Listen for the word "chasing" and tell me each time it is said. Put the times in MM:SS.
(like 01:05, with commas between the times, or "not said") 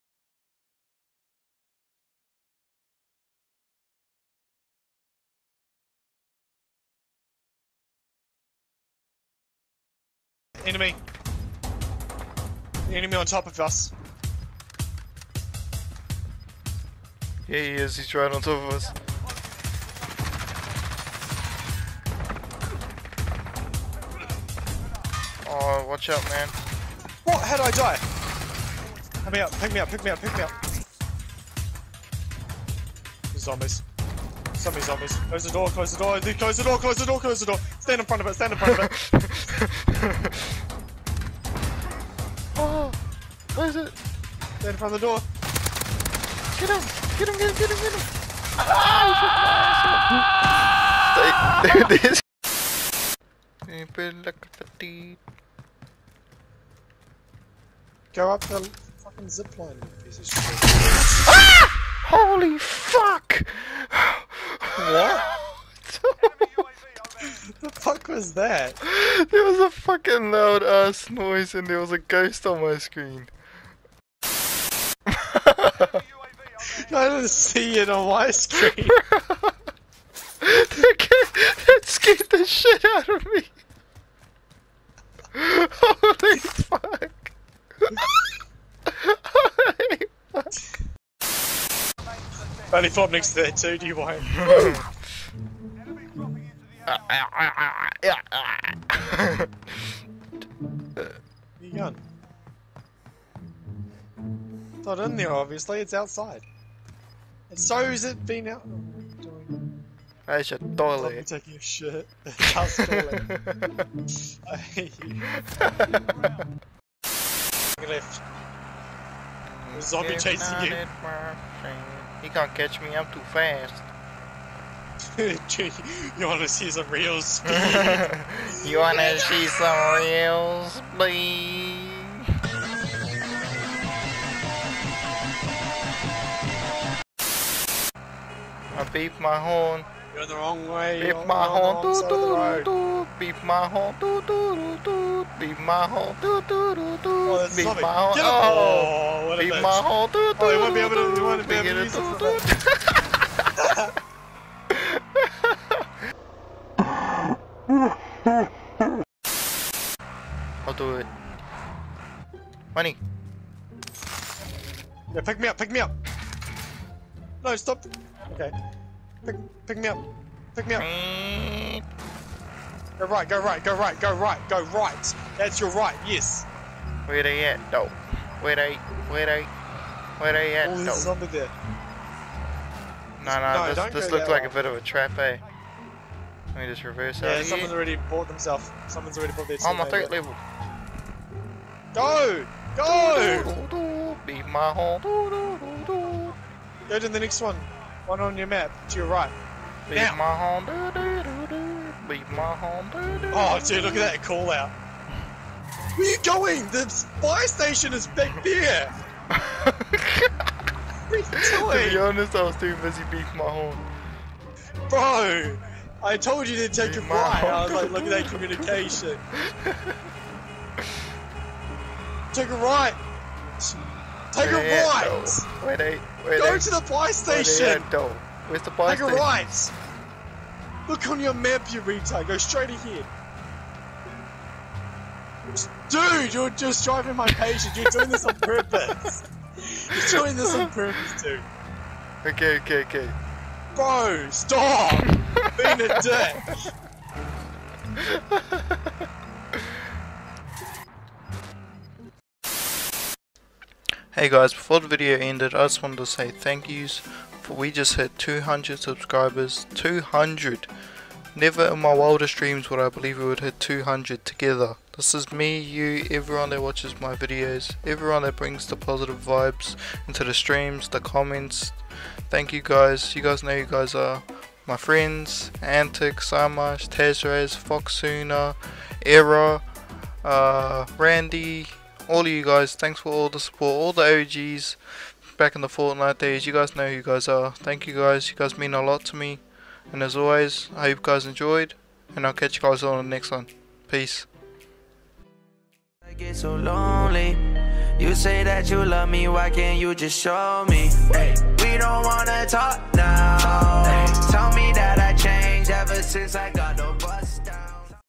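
02:00.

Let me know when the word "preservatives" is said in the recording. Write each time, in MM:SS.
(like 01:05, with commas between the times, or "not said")
not said.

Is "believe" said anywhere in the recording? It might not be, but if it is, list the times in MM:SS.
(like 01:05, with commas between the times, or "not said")
04:22.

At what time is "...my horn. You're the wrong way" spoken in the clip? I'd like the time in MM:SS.
02:19.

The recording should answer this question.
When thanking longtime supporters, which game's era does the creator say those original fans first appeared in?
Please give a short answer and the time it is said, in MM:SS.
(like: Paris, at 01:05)
Fortnite, at 04:45.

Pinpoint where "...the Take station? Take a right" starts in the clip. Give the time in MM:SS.
03:48.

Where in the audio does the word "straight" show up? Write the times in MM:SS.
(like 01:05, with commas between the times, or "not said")
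03:52.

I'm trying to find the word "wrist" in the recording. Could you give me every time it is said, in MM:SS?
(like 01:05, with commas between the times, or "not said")
not said.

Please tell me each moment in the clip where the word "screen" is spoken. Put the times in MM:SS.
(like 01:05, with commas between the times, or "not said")
01:12, 01:18.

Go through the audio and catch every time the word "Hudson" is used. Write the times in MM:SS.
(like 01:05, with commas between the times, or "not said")
not said.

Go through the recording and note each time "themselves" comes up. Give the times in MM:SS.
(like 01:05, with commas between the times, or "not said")
03:08.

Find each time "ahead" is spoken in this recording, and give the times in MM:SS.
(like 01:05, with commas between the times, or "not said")
03:52.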